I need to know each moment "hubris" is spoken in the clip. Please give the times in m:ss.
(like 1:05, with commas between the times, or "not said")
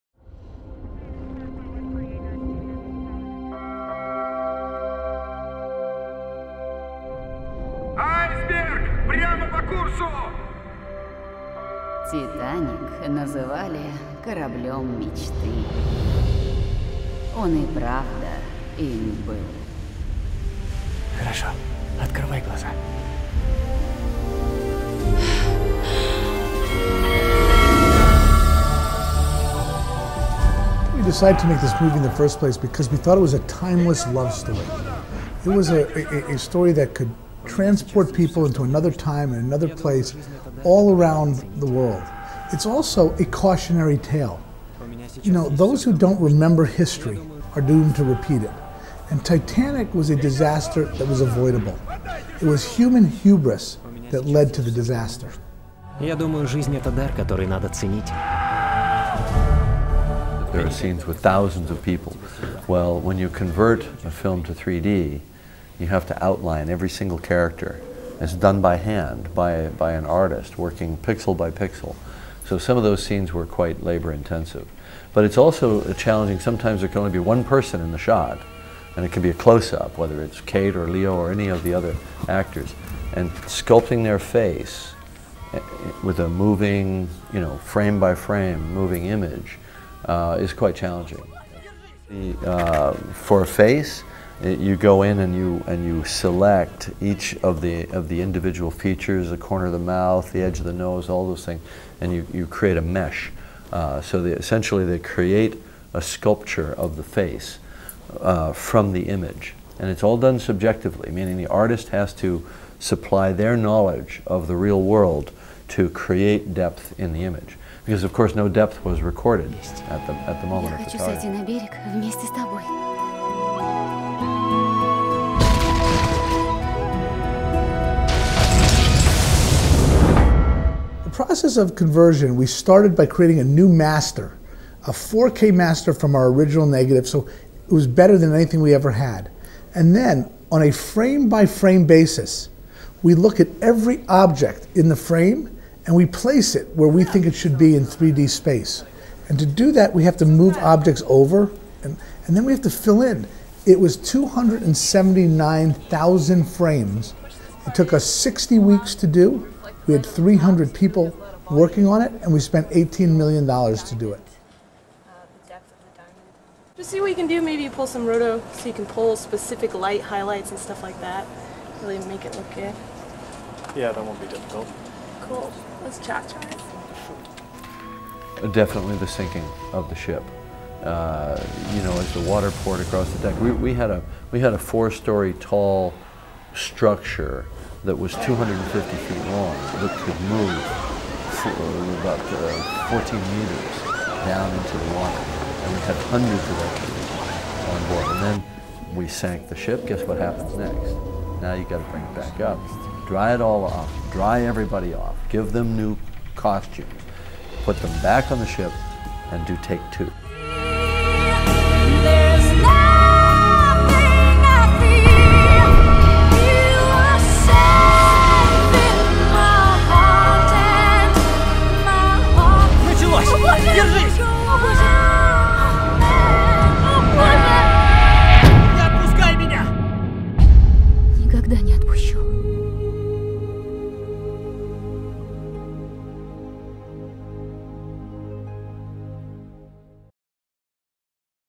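0:53.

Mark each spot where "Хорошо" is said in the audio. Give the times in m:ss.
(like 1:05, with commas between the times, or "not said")
0:21.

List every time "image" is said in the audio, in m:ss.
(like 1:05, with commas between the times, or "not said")
1:29, 1:49, 1:57.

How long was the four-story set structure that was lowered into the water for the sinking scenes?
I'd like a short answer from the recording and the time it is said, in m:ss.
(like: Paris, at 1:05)
250 feet, at 3:08.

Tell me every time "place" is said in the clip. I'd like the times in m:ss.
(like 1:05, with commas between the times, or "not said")
0:32, 0:39, 2:26.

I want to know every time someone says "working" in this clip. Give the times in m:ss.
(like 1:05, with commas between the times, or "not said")
1:10, 2:41.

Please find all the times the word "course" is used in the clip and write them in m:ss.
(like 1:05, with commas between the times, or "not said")
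1:58.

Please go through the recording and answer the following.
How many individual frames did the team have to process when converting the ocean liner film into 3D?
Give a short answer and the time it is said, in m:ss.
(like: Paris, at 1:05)
279,000, at 2:33.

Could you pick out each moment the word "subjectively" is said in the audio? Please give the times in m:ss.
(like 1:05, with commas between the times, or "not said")
1:50.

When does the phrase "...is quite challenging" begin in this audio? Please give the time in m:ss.
1:30.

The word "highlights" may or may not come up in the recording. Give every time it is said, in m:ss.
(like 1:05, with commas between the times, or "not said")
2:50.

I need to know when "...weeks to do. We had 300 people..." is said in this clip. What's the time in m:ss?
2:38.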